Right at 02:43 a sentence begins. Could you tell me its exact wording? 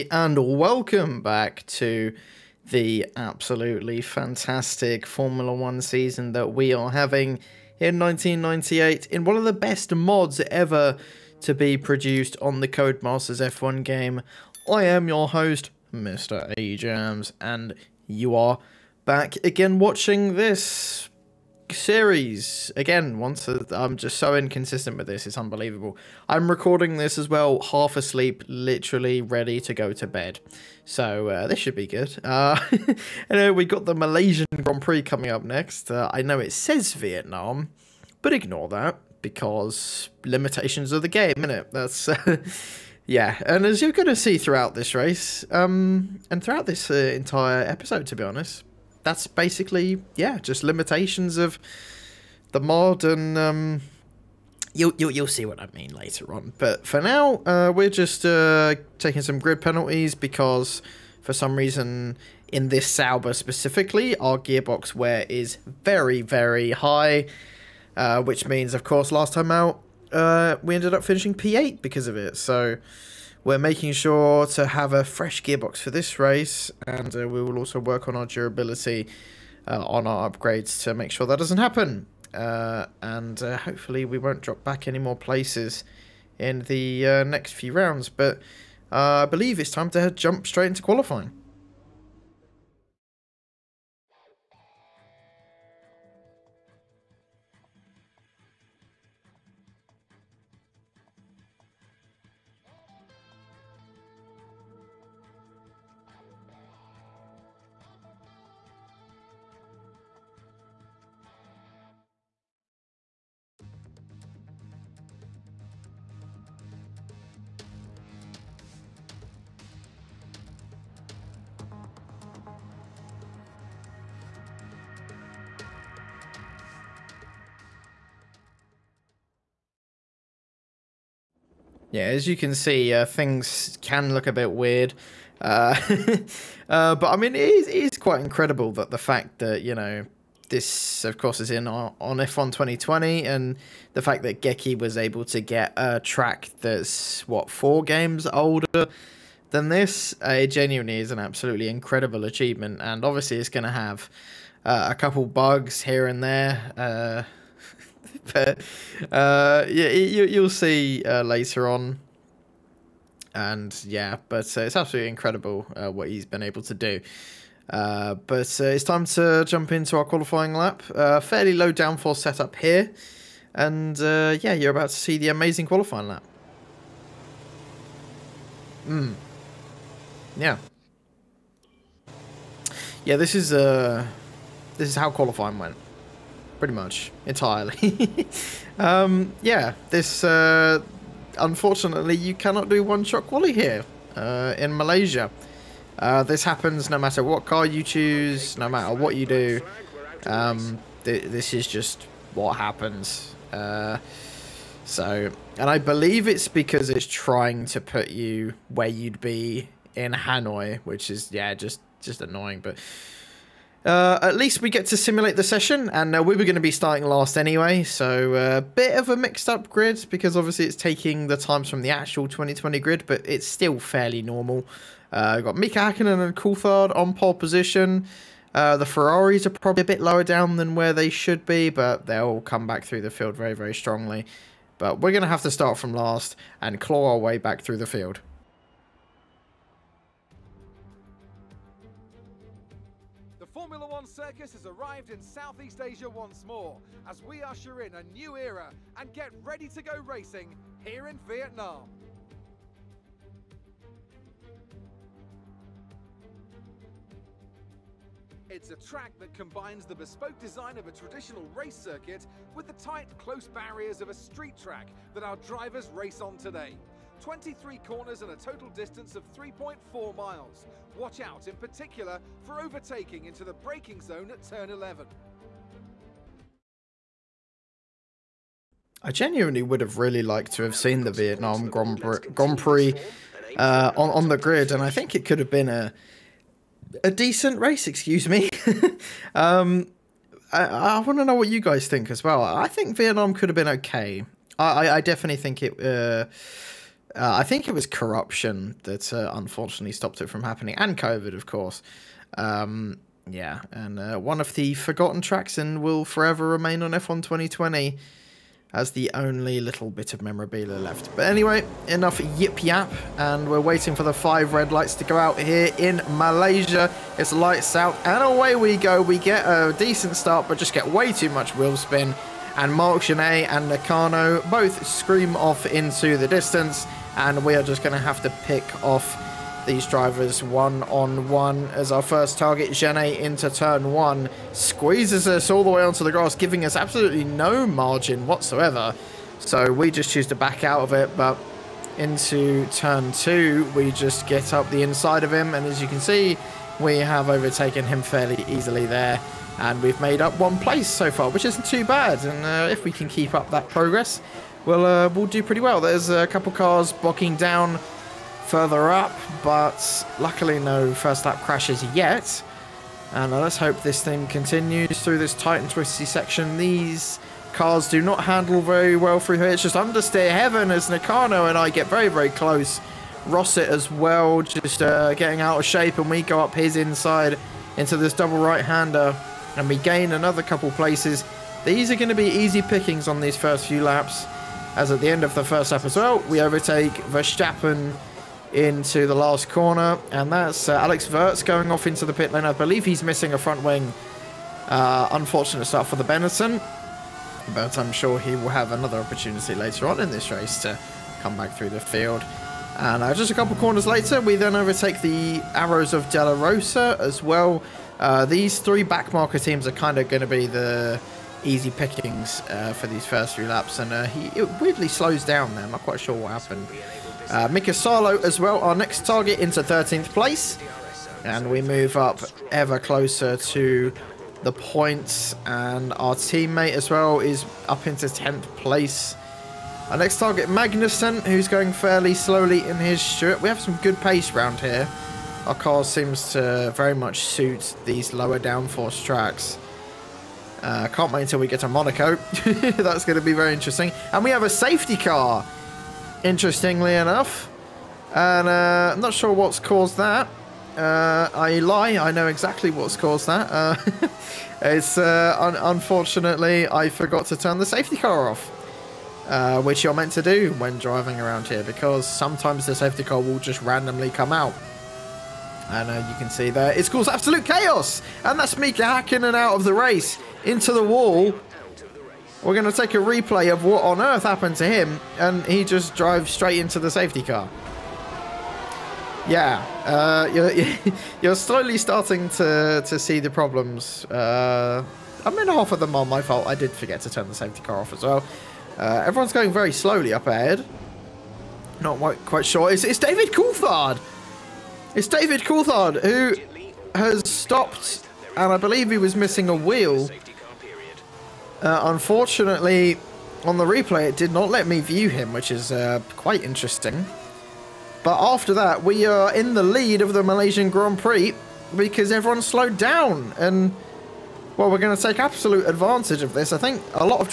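And yeah, but uh, it's absolutely incredible uh, what he's been able to do.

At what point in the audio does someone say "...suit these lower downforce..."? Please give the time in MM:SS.
07:17.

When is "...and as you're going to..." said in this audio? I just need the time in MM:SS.
00:43.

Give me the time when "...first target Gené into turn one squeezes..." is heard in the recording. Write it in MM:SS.
05:32.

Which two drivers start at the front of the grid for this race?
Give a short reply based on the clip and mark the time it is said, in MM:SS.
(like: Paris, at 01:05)
Mika Hakkinen and Coulthard, at 03:45.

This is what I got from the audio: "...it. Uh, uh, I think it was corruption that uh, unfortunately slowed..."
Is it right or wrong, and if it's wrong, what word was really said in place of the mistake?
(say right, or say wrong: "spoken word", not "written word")
wrong: "stopped", not "slowed".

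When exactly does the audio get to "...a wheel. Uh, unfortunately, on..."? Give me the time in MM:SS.
08:19.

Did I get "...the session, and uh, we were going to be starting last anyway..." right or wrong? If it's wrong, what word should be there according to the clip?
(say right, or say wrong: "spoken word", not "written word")
right.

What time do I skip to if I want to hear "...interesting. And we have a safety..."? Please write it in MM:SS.
07:23.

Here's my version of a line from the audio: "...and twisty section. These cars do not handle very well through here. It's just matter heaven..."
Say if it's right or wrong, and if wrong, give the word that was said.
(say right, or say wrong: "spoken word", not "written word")
wrong: "understeer", not "matter".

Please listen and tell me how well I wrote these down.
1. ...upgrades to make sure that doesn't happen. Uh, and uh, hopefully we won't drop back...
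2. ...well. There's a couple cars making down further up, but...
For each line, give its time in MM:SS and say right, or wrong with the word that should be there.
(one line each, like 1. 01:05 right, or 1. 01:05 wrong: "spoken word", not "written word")
1. 01:20 right
2. 05:55 wrong: "blocking", not "making".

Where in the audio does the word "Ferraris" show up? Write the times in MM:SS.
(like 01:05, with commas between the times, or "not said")
03:48.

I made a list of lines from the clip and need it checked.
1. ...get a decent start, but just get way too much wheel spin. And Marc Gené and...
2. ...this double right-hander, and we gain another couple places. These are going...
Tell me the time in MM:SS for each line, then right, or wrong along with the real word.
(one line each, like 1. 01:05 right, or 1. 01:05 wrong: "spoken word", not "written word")
1. 05:19 right
2. 06:17 right.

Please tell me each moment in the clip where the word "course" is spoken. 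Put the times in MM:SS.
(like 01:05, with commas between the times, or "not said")
01:08, 02:21, 05:01.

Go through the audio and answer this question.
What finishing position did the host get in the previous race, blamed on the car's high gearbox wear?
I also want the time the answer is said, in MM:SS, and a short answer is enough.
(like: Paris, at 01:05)
P8, at 01:11.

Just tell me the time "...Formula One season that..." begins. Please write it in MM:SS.
00:05.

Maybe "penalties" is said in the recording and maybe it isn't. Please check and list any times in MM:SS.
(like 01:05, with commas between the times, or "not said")
00:59.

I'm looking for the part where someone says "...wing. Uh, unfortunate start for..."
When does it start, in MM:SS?
06:33.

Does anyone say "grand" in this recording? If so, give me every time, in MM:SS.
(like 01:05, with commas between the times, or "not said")
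00:34, 04:41, 08:30.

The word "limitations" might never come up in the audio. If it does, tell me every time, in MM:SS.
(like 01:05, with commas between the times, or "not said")
00:40, 00:50.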